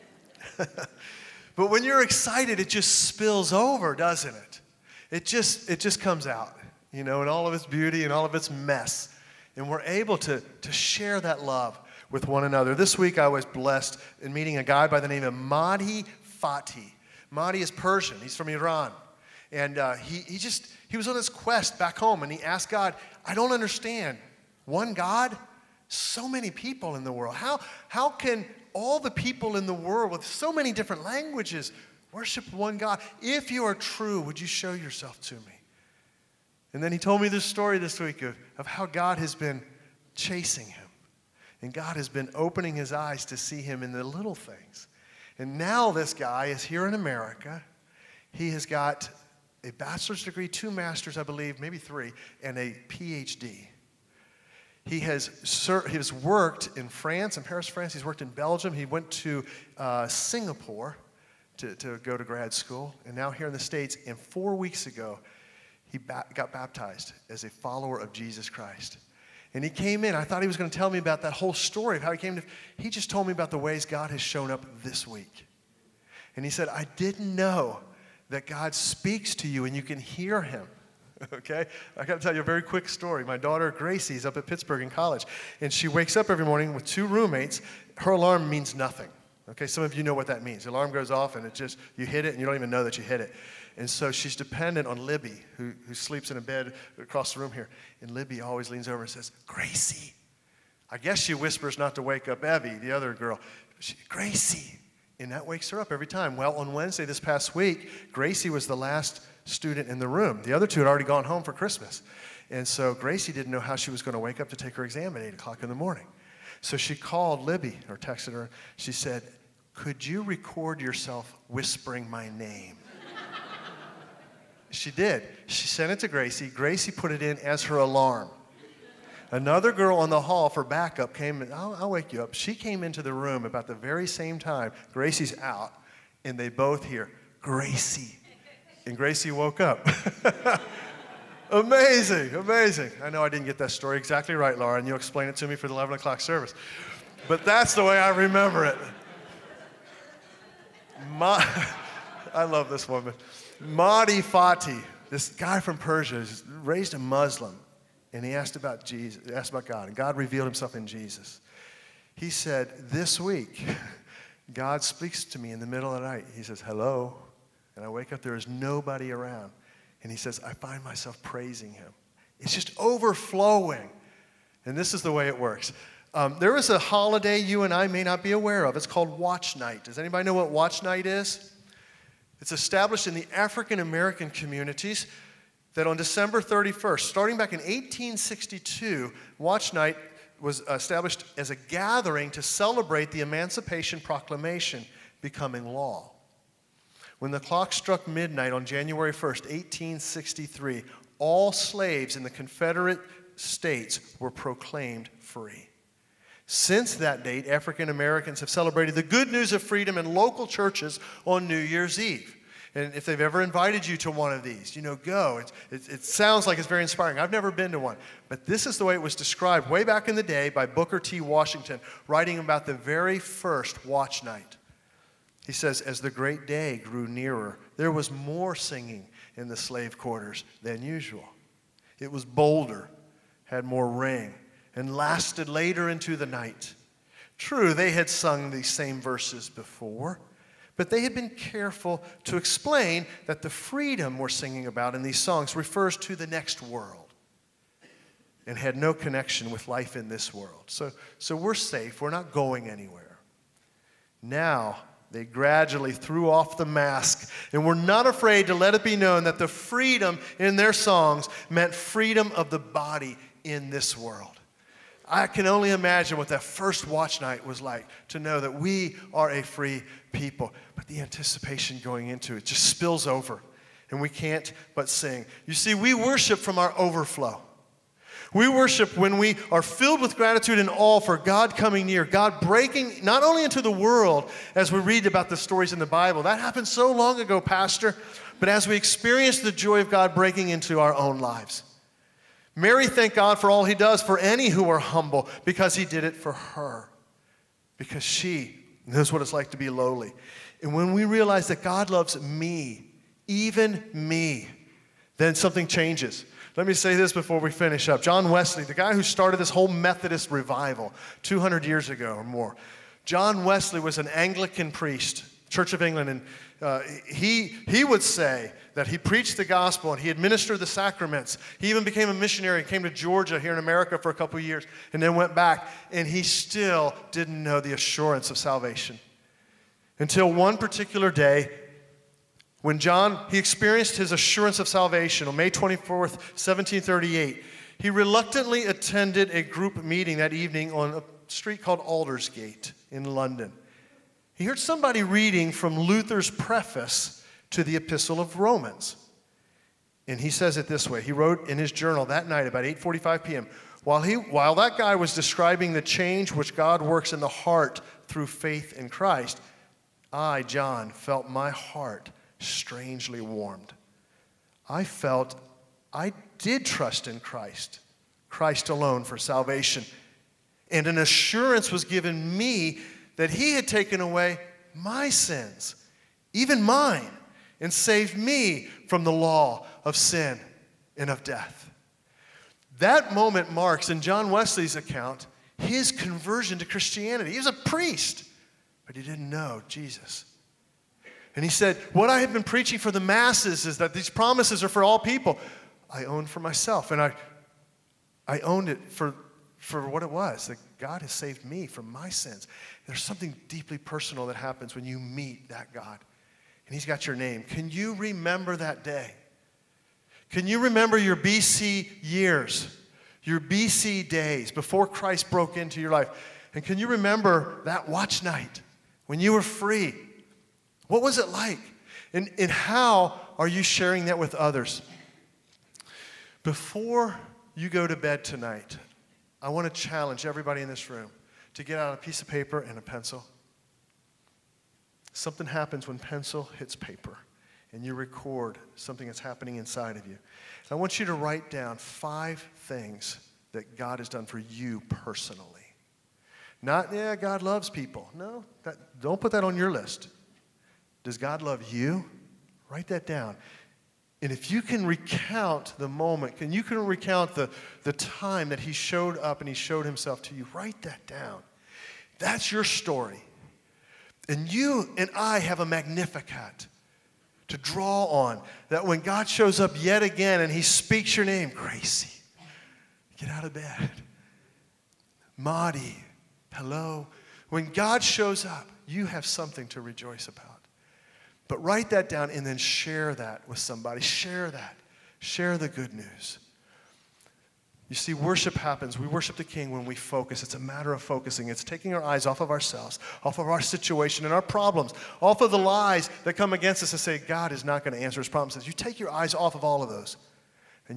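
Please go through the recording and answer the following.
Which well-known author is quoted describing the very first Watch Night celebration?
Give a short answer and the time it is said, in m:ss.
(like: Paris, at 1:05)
Booker T. Washington, at 3:40.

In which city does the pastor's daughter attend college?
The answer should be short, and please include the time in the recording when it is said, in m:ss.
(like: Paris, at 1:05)
Pittsburgh, at 1:24.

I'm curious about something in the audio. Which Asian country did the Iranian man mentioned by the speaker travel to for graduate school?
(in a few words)
Singapore.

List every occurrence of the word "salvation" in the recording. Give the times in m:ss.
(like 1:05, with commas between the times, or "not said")
5:28, 5:34, 6:09.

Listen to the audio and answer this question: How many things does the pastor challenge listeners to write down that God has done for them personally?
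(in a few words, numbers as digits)
5.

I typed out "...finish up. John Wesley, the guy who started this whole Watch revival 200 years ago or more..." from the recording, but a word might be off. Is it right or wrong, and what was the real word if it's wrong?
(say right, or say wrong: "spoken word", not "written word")
wrong: "Methodist", not "Watch".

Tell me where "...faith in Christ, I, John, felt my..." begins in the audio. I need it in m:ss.
5:58.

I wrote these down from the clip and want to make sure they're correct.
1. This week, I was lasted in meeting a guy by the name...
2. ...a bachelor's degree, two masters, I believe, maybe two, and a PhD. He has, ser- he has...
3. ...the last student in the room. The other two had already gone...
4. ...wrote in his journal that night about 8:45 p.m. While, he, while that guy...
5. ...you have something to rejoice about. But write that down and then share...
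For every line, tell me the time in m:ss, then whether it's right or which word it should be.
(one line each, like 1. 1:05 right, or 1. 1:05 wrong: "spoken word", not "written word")
1. 0:12 wrong: "blessed", not "lasted"
2. 0:49 wrong: "three", not "two"
3. 1:48 right
4. 5:51 right
5. 7:58 right.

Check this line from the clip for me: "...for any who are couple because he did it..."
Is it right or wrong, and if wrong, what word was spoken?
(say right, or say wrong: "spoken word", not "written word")
wrong: "humble", not "couple".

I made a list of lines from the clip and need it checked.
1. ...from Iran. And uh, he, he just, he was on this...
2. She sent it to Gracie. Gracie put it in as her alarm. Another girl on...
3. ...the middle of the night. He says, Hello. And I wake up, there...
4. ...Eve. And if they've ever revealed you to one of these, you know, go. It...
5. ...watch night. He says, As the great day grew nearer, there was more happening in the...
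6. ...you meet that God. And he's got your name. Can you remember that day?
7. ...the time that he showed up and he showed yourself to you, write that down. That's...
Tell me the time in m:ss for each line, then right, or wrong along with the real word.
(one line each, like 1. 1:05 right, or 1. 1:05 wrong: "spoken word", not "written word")
1. 0:18 right
2. 2:05 right
3. 2:45 right
4. 3:31 wrong: "invited", not "revealed"
5. 3:43 wrong: "singing", not "happening"
6. 6:44 right
7. 7:37 wrong: "himself", not "yourself".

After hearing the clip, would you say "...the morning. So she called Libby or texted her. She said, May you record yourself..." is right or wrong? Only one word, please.
wrong.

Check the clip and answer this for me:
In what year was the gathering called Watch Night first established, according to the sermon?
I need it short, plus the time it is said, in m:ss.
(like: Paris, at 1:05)
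1862, at 3:07.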